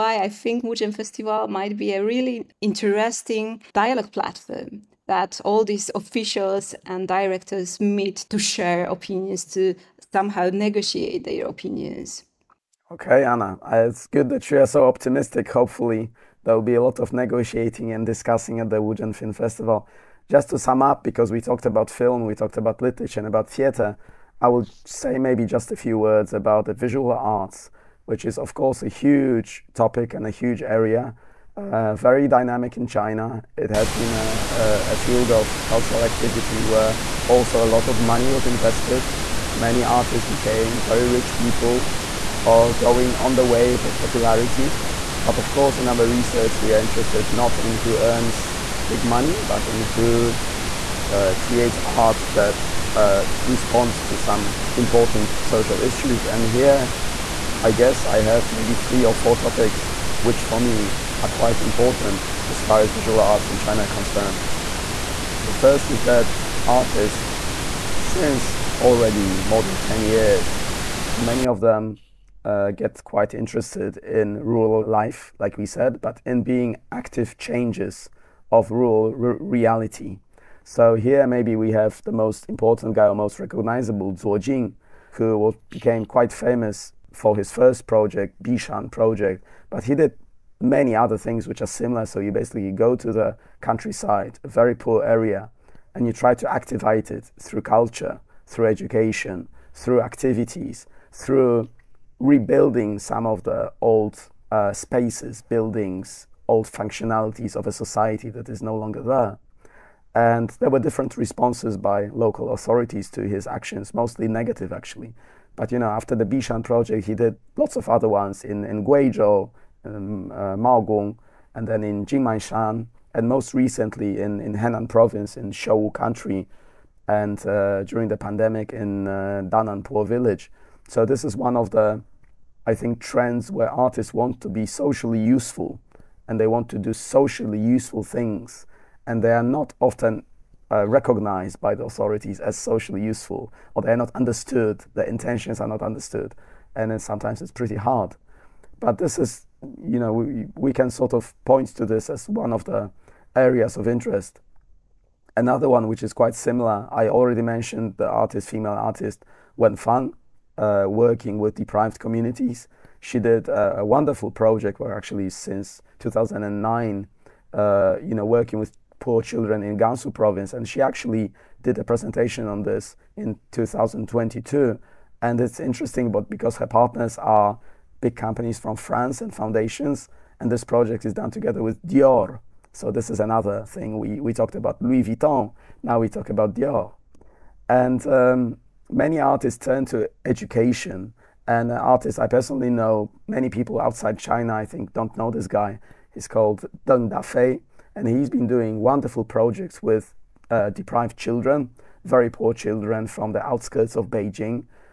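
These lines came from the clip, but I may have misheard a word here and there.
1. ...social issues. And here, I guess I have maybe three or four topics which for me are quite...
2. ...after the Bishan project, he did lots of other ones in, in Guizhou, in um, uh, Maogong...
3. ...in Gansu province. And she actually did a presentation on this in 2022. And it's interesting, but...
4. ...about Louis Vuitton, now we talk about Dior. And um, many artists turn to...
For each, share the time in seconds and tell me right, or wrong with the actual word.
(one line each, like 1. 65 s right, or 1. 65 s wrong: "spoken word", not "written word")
1. 55 s right
2. 115 s right
3. 169 s right
4. 184 s right.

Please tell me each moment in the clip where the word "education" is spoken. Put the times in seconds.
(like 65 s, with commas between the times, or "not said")
98 s, 190 s.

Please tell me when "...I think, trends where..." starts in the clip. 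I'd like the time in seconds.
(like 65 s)
132 s.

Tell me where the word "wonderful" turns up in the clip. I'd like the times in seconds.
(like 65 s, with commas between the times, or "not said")
163 s, 198 s.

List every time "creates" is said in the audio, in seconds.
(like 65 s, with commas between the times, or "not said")
51 s.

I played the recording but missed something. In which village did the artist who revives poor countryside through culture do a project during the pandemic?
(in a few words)
Dananpo.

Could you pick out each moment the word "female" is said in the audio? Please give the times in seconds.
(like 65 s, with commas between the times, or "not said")
158 s.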